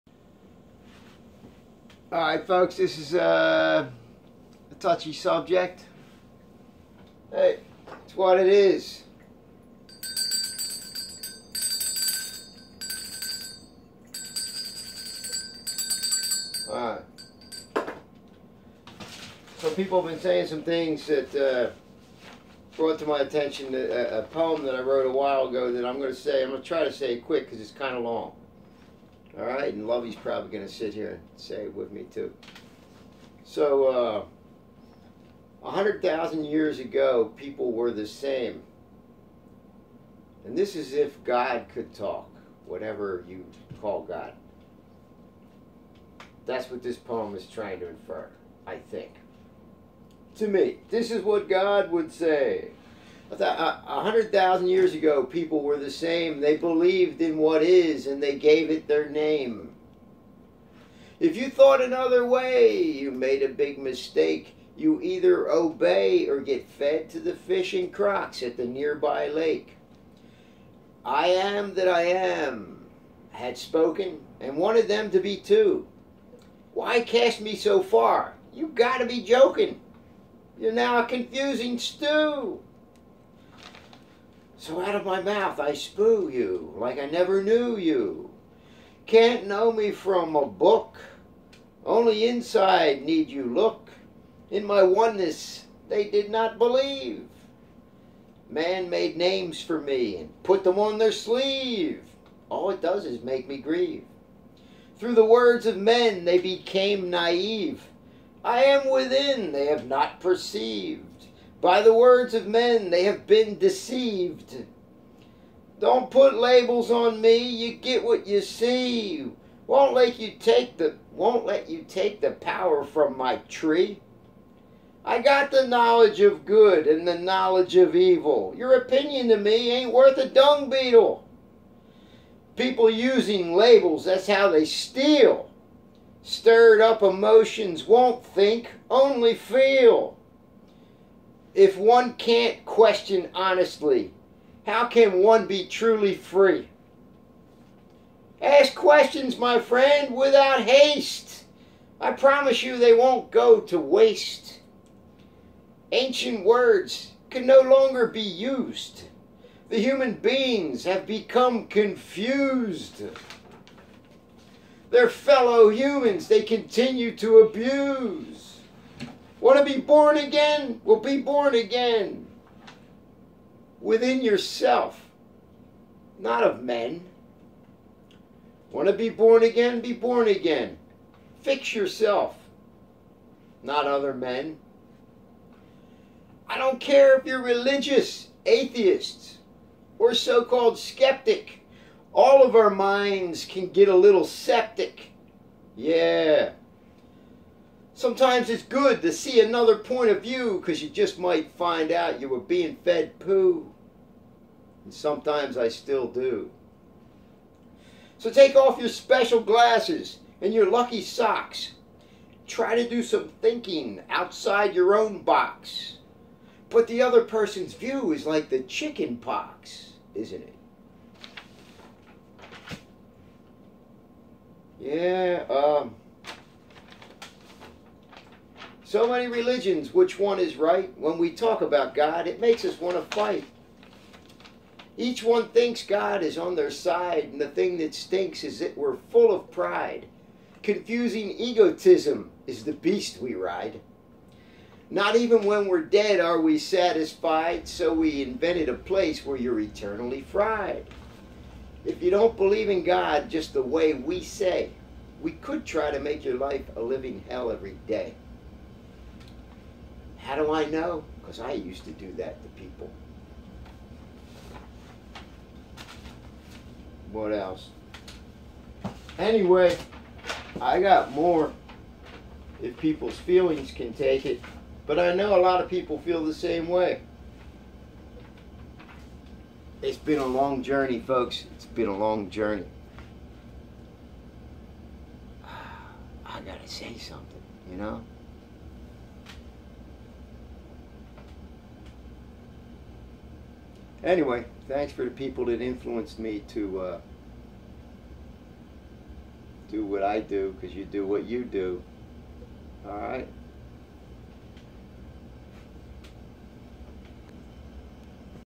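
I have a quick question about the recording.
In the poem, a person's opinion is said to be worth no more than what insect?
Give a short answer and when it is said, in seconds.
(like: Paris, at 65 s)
dung beetle, at 130 s.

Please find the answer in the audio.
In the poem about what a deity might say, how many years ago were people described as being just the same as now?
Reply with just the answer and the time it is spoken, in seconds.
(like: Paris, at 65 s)
100,000, at 35 s.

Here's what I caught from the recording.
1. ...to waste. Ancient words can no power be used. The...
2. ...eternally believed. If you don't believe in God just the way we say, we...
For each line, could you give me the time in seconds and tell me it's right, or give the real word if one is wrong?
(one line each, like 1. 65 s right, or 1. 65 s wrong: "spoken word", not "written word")
1. 153 s wrong: "longer", not "power"
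2. 249 s wrong: "fried", not "believed".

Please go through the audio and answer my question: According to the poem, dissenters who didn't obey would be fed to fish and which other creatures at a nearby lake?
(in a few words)
crocs.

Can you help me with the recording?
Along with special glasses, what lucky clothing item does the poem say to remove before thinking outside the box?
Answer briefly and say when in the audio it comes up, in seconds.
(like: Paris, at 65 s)
lucky socks, at 210 s.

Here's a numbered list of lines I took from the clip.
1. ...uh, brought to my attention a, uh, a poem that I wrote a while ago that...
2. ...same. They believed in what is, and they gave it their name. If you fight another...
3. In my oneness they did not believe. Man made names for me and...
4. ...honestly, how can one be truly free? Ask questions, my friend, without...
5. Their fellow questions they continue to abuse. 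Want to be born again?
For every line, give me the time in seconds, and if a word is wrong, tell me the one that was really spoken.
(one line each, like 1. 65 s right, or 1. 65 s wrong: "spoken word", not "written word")
1. 21 s right
2. 55 s wrong: "thought", not "fight"
3. 94 s right
4. 143 s right
5. 164 s wrong: "humans", not "questions".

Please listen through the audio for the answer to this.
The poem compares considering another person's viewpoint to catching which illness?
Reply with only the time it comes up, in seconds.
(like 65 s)
218 s.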